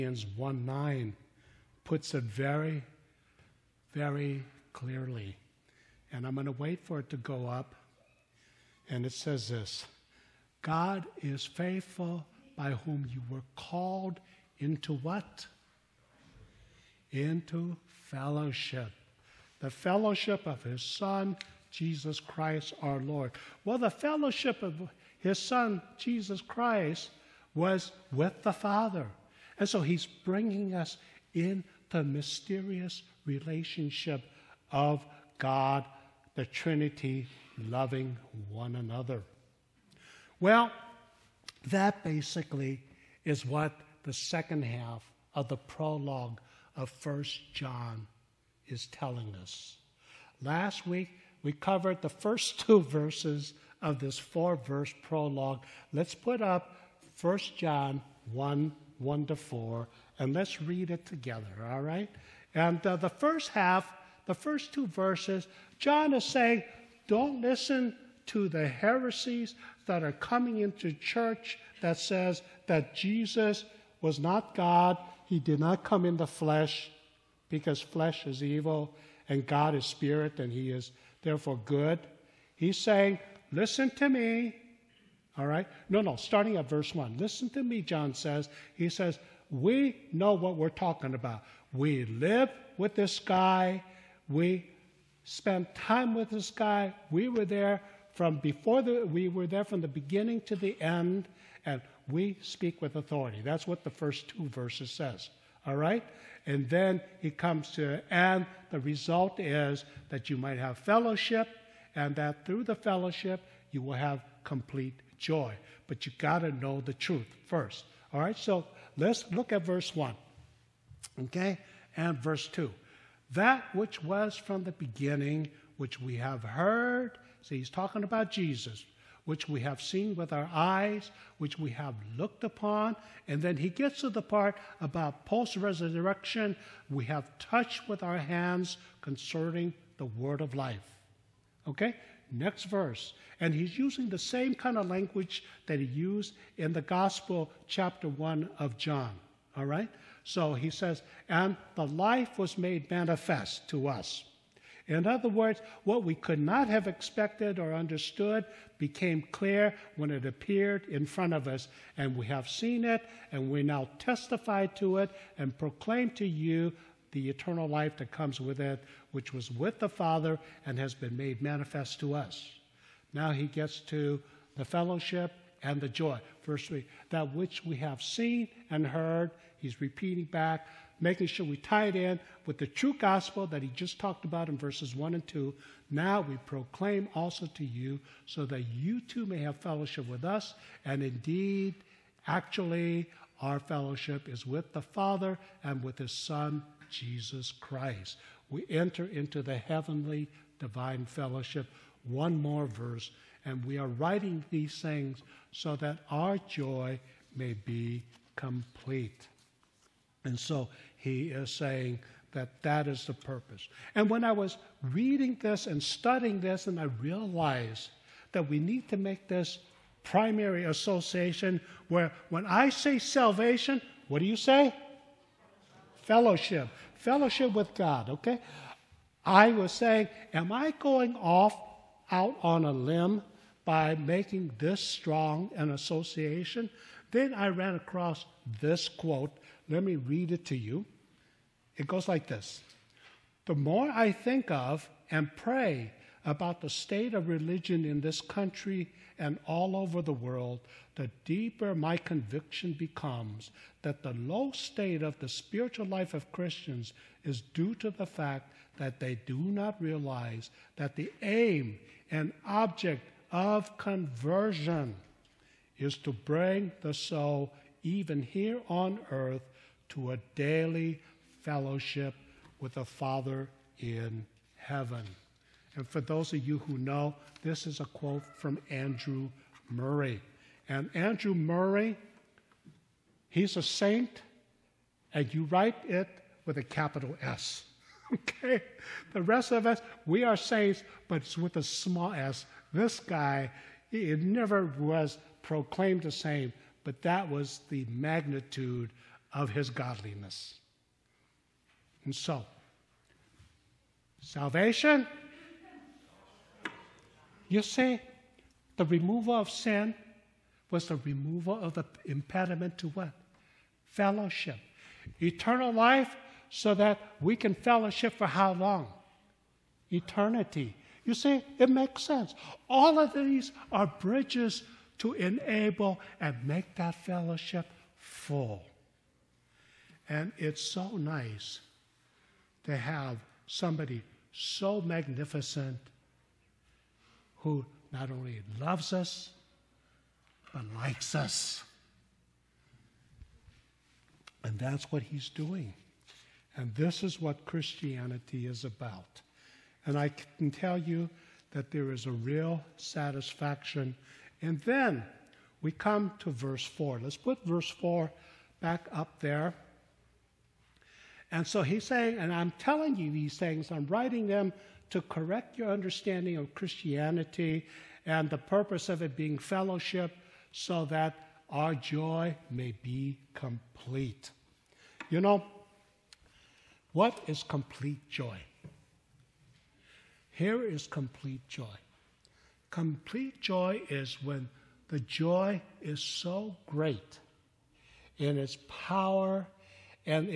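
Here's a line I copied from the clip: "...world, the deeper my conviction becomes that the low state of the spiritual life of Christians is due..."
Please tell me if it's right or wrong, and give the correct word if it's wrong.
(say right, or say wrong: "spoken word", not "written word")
right.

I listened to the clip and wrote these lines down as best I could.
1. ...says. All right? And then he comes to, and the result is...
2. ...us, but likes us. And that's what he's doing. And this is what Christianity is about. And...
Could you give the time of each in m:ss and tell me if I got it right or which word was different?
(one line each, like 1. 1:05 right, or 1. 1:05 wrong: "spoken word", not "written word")
1. 1:44 right
2. 5:38 right.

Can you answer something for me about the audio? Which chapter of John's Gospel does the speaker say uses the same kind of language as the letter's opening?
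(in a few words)
Chapter 1.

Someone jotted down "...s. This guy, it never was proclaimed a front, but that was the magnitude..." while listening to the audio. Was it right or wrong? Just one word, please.
wrong.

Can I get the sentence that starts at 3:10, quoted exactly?
And indeed, actually, our fellowship is with the Father and with his Son, Jesus Christ.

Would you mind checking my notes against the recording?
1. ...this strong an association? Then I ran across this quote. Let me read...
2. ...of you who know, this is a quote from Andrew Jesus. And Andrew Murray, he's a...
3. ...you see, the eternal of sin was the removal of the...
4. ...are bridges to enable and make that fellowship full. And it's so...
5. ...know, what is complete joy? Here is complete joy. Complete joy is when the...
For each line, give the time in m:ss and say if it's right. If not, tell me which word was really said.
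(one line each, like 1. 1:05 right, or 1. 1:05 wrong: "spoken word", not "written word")
1. 3:54 right
2. 4:36 wrong: "Murray", not "Jesus"
3. 5:07 wrong: "removal", not "eternal"
4. 5:23 right
5. 6:15 right.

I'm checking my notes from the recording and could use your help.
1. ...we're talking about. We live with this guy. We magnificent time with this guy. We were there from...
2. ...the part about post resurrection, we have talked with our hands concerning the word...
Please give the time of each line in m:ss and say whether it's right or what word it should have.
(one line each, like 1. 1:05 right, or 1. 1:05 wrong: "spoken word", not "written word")
1. 1:30 wrong: "spent", not "magnificent"
2. 2:14 wrong: "touched", not "talked".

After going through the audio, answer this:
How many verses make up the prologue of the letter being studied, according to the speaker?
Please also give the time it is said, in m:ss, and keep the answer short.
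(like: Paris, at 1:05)
4, at 0:54.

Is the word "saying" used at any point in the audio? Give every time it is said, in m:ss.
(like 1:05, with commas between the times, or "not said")
1:06, 1:22, 3:31, 3:49, 6:01.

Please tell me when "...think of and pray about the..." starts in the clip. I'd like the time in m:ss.
4:04.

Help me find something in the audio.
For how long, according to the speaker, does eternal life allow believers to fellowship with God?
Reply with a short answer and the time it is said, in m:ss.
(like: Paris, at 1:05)
Eternity, at 5:19.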